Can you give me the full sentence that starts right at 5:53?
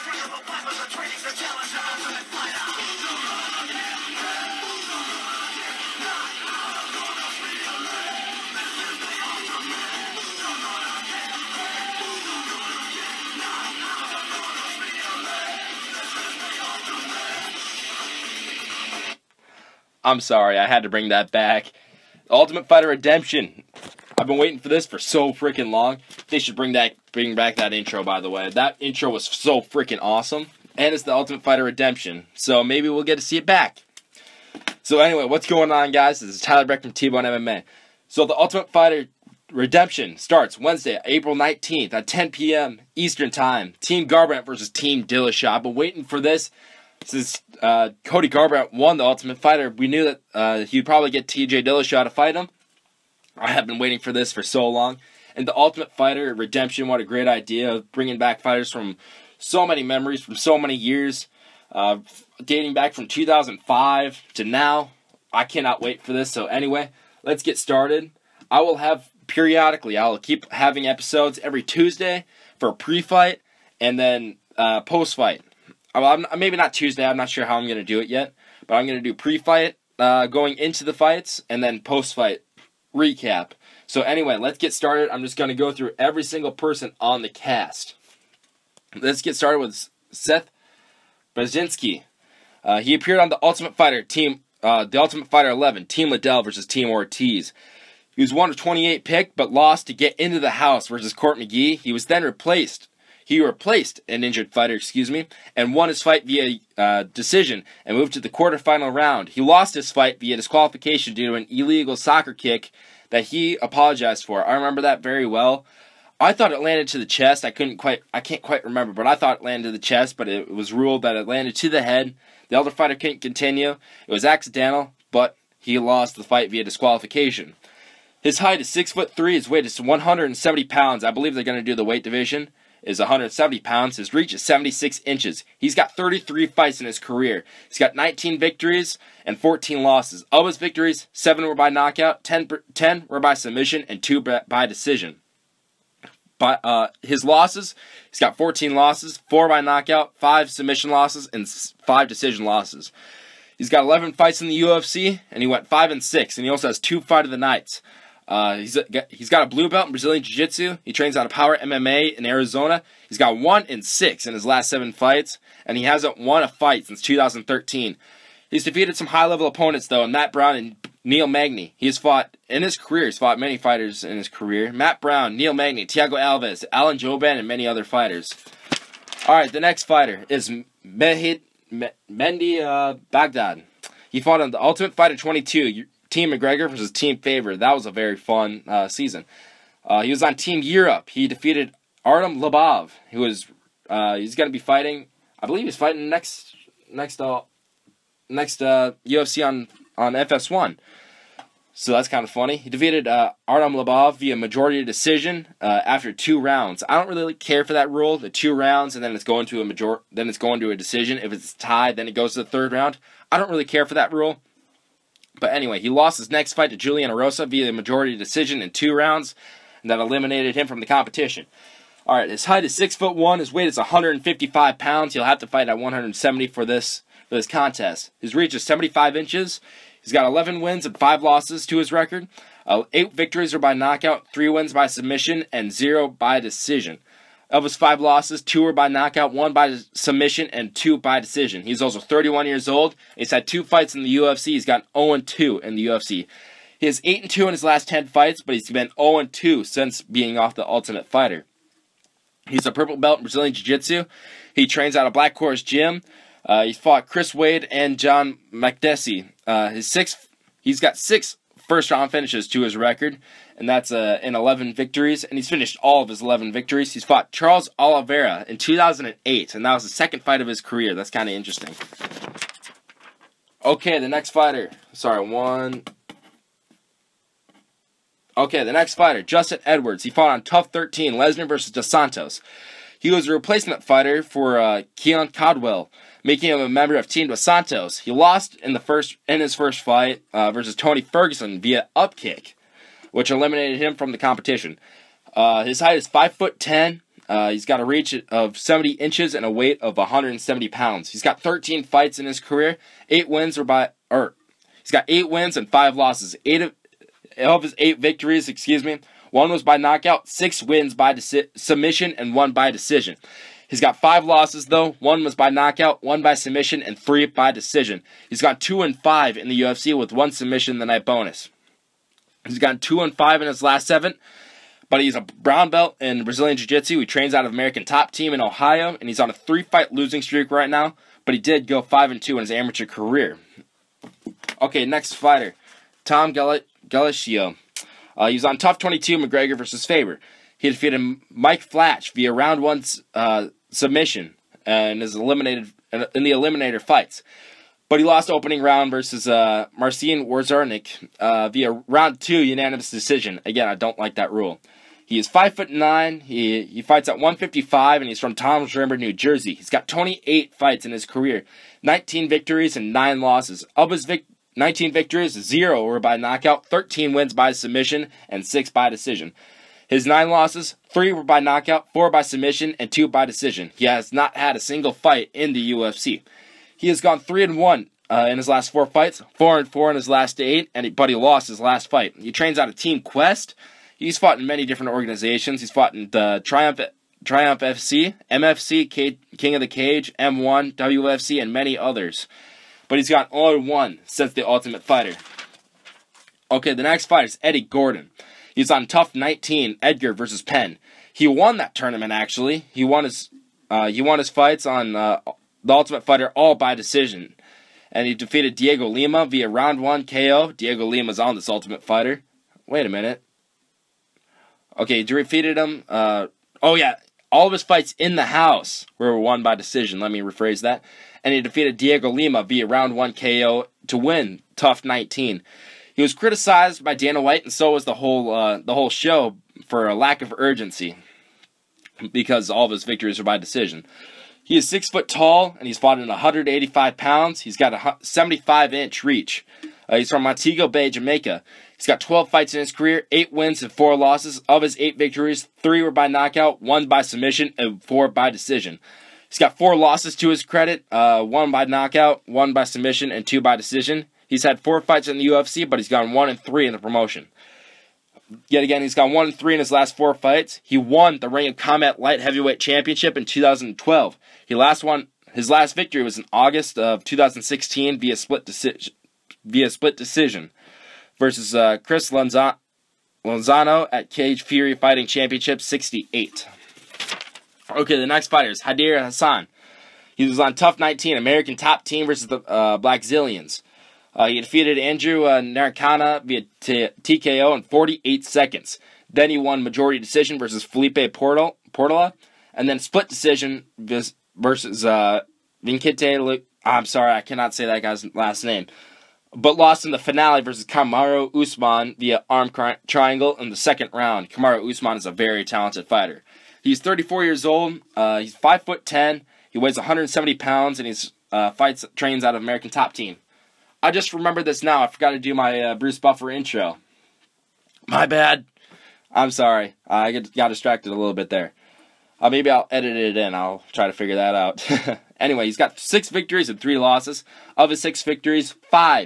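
Again, I don't like that rule.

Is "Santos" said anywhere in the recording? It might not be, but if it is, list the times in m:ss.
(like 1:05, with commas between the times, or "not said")
4:41, 4:47.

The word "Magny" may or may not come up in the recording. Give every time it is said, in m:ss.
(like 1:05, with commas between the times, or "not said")
2:51, 2:55.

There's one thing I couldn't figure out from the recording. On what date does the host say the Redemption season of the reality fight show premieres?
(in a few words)
April 19th.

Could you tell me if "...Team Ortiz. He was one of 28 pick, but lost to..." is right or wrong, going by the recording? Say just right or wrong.
right.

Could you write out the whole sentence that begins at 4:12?
He's a purple belt in Brazilian Jiu Jitsu.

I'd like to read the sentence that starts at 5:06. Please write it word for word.
Eight of, of his eight victories, excuse me, one was by knockout, six wins by deci- submission, and one by decision.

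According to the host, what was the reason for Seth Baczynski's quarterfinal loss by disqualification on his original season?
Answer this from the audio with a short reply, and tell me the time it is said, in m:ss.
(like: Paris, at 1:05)
illegal soccer kick, at 1:51.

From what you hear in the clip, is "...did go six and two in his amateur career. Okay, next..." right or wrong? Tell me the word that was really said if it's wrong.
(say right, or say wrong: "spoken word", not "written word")
wrong: "five", not "six".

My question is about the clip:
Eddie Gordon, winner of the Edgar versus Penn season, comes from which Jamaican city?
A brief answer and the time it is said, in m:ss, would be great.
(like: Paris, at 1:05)
Montego Bay, at 7:20.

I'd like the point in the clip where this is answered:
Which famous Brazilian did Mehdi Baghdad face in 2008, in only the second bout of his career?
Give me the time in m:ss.
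4:27.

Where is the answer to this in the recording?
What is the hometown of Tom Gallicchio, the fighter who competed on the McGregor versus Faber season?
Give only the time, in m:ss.
5:58.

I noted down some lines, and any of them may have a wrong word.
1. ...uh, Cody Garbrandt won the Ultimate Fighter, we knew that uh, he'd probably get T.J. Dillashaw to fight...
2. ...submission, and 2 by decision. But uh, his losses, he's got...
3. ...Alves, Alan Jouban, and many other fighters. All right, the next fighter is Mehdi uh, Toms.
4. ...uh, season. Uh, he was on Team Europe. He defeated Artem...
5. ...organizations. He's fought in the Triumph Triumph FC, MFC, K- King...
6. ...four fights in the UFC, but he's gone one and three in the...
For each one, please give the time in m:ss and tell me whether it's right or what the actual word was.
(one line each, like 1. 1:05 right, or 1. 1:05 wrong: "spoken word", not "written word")
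1. 0:47 right
2. 2:23 right
3. 2:56 wrong: "Baghdad", not "Toms"
4. 3:08 right
5. 6:24 right
6. 7:34 right.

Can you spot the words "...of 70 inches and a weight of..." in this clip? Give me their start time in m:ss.
4:58.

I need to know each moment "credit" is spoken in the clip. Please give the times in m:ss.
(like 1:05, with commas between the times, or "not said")
7:30.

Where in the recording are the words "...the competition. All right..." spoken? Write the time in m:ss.
3:40.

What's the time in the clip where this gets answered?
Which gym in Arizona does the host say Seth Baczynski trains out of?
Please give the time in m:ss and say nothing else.
2:41.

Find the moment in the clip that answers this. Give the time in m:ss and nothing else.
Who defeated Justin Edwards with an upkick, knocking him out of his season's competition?
4:50.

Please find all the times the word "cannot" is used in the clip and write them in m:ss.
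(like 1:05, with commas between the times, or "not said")
1:05, 8:17.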